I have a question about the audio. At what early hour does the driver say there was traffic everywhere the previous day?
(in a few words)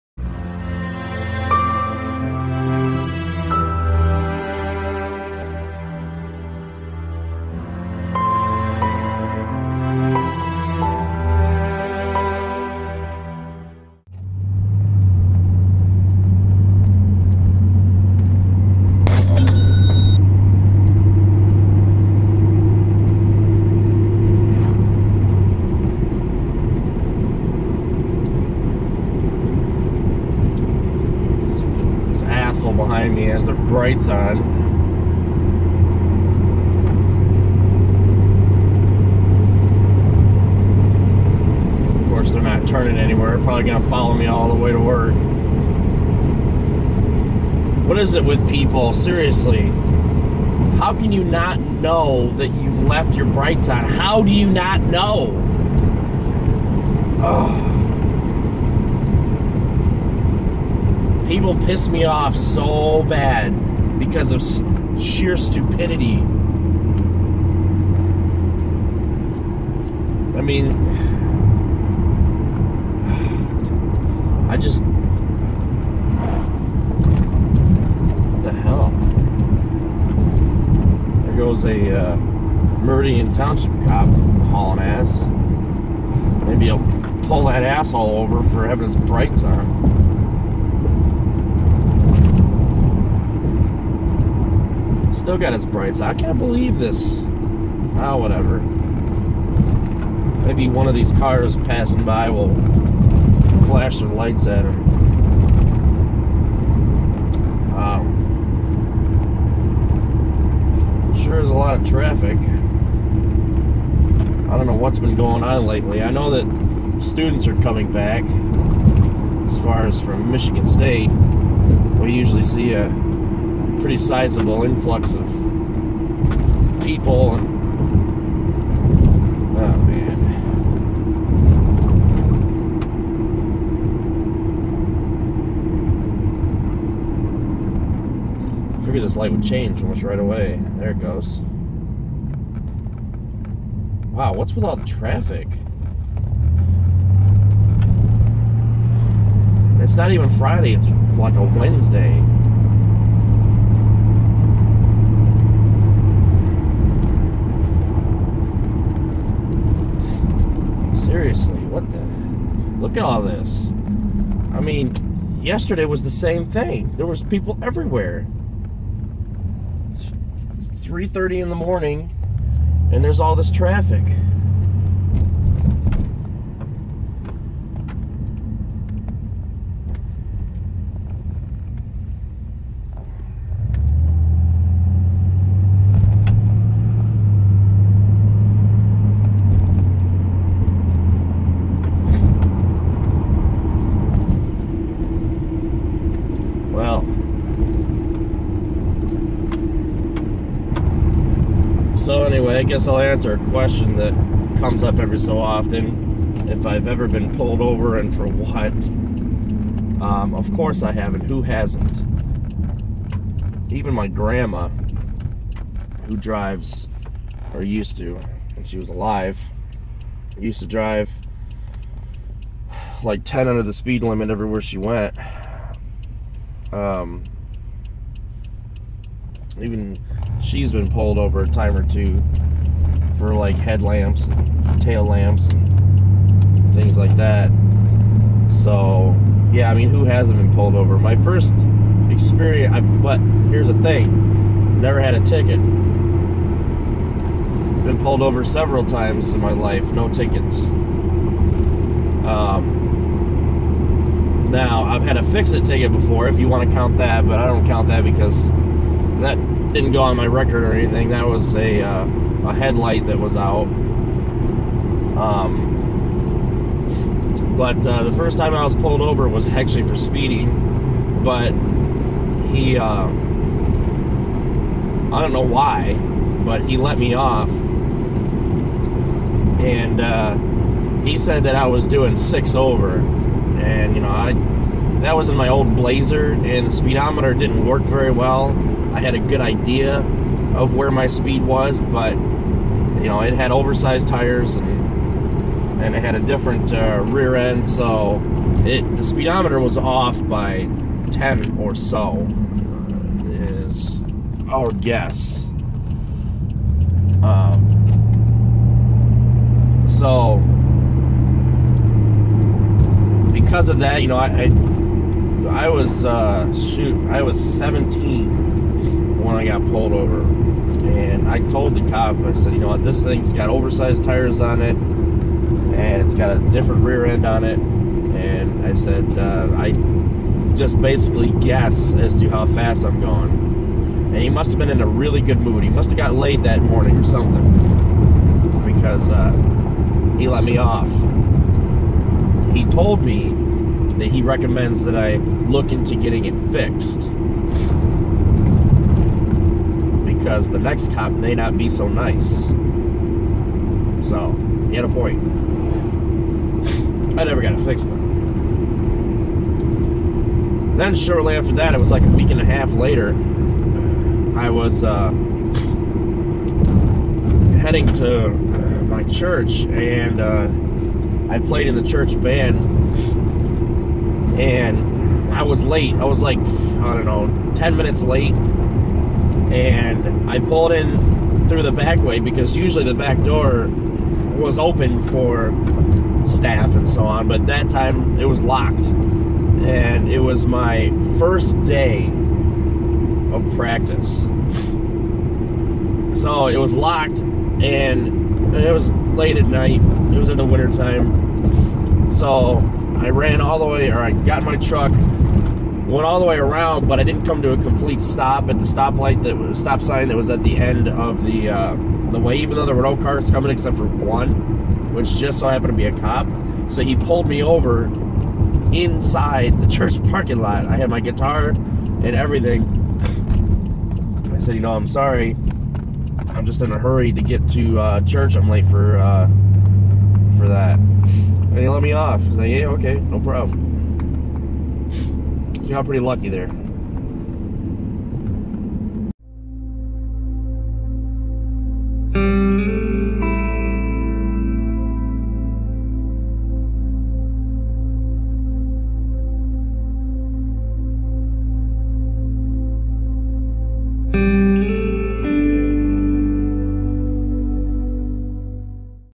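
3:30 in the morning.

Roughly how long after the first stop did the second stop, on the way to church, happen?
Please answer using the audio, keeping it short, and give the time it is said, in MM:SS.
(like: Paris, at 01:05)
a week and a half, at 06:02.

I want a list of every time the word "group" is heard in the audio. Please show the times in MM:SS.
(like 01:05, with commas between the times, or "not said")
not said.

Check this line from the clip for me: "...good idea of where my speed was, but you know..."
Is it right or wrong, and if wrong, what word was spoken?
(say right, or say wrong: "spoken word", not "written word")
right.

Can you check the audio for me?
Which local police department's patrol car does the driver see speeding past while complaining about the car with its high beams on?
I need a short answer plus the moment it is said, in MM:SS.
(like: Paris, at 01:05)
Meridian Township, at 01:22.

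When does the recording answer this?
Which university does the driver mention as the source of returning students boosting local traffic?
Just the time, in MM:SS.
02:00.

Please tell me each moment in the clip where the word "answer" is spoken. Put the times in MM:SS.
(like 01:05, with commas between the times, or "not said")
03:22.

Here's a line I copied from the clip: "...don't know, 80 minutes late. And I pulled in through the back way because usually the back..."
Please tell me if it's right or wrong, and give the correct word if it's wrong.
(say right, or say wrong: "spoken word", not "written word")
wrong: "10", not "80".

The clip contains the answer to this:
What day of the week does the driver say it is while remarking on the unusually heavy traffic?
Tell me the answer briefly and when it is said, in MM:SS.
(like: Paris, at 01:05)
Wednesday, at 02:31.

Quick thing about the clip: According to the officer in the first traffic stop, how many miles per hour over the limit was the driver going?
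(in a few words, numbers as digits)
6.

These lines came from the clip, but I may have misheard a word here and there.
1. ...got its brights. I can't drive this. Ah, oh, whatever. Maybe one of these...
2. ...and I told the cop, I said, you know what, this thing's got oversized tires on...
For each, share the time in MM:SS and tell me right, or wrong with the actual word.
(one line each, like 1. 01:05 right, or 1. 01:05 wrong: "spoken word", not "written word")
1. 01:35 wrong: "believe", not "drive"
2. 05:20 right.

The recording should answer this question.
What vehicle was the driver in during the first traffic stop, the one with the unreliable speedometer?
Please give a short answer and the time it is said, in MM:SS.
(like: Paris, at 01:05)
Blazer, at 04:45.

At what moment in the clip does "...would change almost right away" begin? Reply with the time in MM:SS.
02:19.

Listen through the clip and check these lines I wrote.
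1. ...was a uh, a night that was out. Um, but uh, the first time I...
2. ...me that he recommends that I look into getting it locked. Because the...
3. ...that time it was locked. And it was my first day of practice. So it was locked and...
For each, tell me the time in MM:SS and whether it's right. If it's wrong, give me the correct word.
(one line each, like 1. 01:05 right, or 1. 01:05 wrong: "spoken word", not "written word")
1. 04:21 wrong: "headlight", not "night"
2. 05:43 wrong: "fixed", not "locked"
3. 06:27 right.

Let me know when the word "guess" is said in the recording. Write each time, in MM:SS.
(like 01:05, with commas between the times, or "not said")
03:22, 05:04, 05:31.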